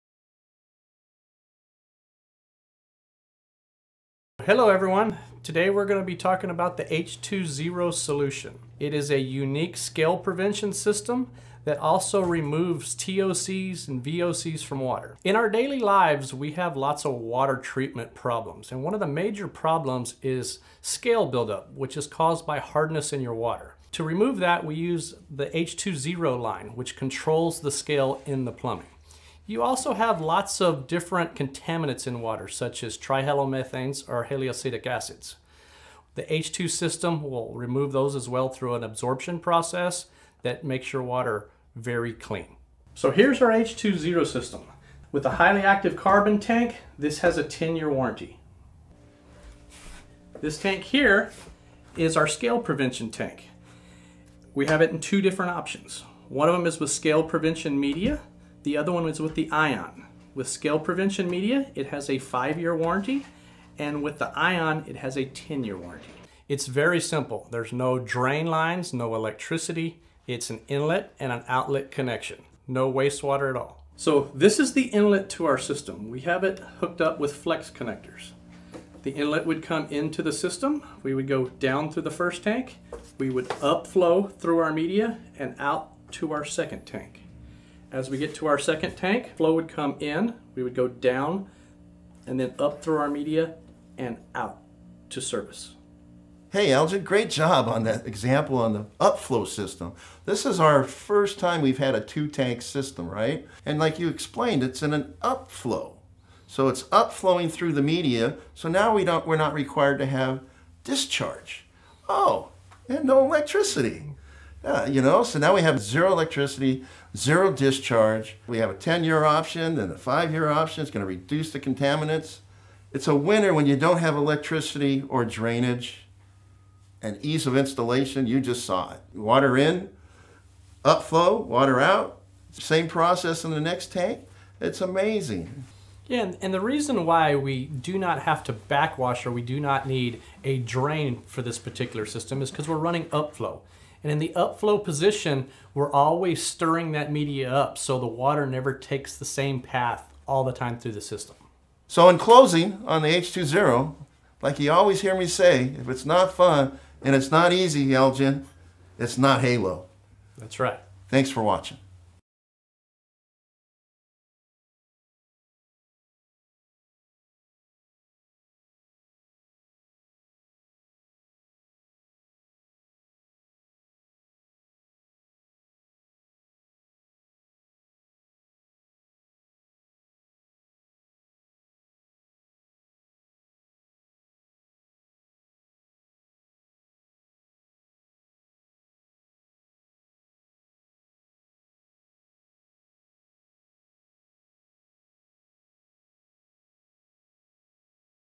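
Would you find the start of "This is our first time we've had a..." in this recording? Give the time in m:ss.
1:40.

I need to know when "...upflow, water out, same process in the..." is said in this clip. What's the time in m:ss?
2:10.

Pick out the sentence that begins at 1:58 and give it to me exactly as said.
We have a 10 year option, then a five year option.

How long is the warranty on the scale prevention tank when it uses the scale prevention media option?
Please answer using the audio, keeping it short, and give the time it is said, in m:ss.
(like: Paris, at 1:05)
5 years, at 1:02.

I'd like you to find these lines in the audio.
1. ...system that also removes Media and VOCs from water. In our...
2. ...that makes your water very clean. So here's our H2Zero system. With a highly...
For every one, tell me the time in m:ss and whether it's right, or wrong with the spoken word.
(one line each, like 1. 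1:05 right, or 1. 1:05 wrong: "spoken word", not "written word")
1. 0:10 wrong: "TOCs", not "Media"
2. 0:40 right.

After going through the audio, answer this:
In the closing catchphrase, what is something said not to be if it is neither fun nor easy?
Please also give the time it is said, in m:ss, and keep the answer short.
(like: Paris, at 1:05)
Halo, at 2:39.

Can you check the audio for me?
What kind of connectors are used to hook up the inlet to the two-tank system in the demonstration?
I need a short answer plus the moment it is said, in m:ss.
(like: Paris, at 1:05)
flex connectors, at 1:17.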